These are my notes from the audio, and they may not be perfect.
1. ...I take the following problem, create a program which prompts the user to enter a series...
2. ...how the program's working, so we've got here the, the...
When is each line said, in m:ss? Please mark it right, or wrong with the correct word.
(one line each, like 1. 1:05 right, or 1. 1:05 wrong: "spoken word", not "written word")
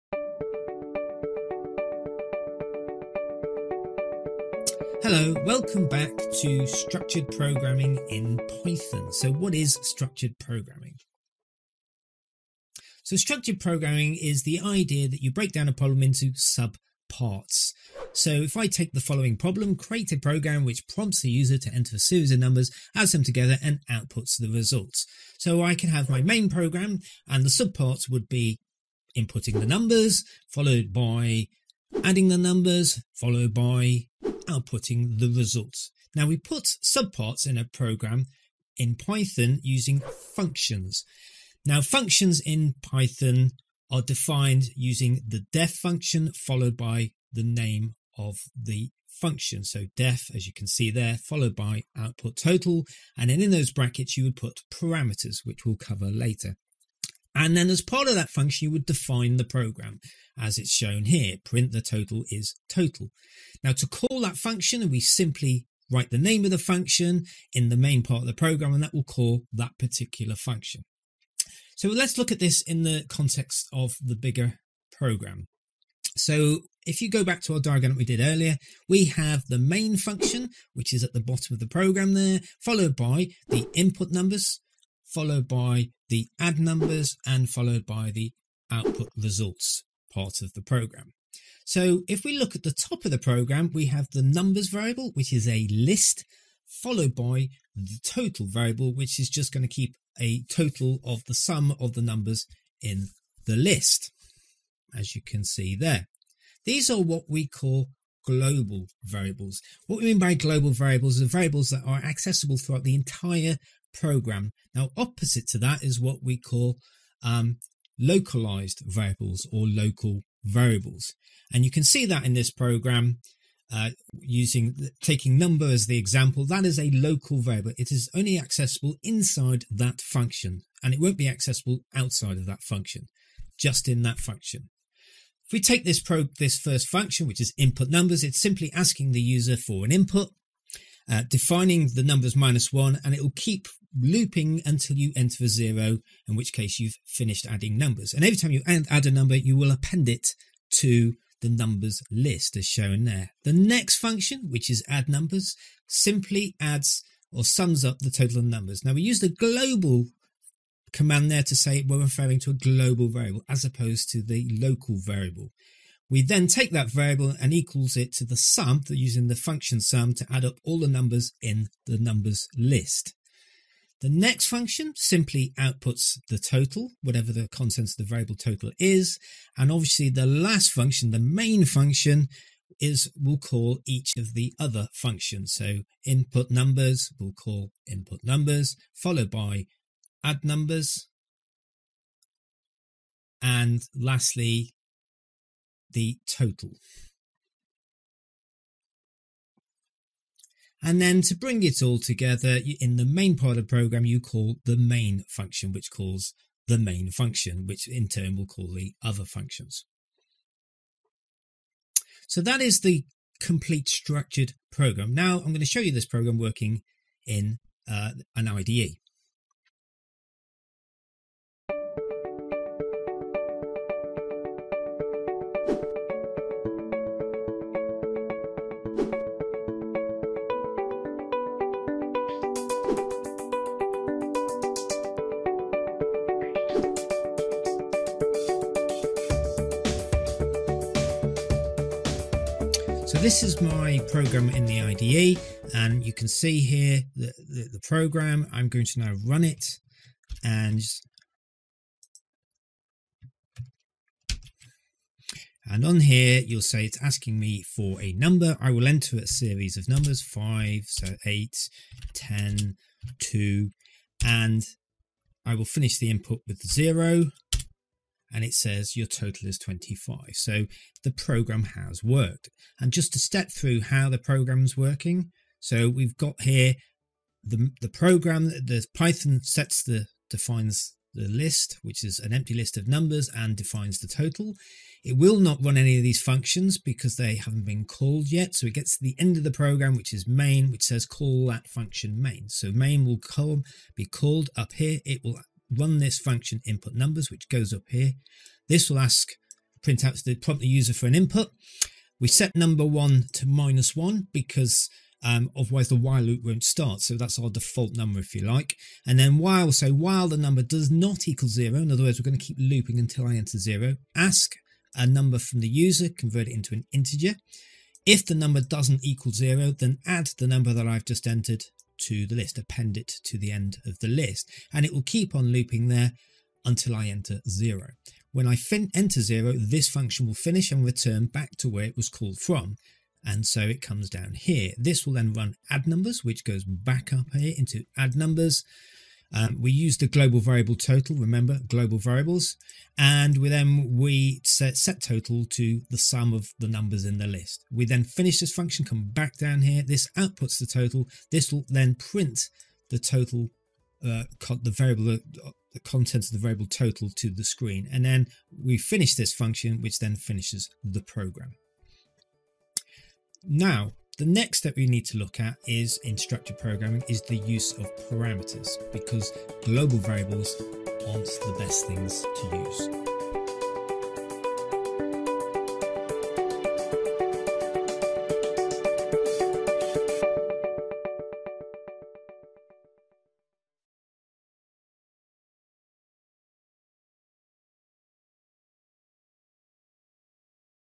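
1. 0:18 right
2. 4:33 right.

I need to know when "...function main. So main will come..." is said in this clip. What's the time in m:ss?
4:51.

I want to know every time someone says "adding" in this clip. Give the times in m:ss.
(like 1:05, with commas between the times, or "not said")
0:32, 2:27.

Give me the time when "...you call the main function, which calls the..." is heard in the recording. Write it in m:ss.
3:24.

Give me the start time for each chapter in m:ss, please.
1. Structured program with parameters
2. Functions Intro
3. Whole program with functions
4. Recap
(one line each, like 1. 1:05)
1. 4:05
2. 0:44
3. 1:15
4. 3:42.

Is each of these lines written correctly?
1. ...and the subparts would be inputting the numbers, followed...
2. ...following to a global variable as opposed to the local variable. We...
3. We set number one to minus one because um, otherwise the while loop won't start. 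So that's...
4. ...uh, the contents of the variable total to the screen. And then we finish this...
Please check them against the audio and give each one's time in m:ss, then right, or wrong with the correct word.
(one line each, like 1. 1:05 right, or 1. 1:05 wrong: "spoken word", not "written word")
1. 0:27 right
2. 2:41 wrong: "referring", not "following"
3. 5:02 right
4. 5:55 right.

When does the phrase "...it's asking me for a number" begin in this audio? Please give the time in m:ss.
4:16.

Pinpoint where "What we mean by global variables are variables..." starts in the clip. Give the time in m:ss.
1:49.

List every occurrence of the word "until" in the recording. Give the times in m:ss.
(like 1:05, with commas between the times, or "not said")
2:24, 5:12, 5:26.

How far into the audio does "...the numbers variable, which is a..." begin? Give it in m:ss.
1:34.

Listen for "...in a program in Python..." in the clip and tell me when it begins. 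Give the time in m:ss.
0:37.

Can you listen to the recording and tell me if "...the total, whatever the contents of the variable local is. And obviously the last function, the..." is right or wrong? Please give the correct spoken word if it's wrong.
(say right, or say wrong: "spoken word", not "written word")
wrong: "total", not "local".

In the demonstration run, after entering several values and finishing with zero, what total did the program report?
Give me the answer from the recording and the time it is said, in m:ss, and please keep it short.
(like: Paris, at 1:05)
25, at 4:29.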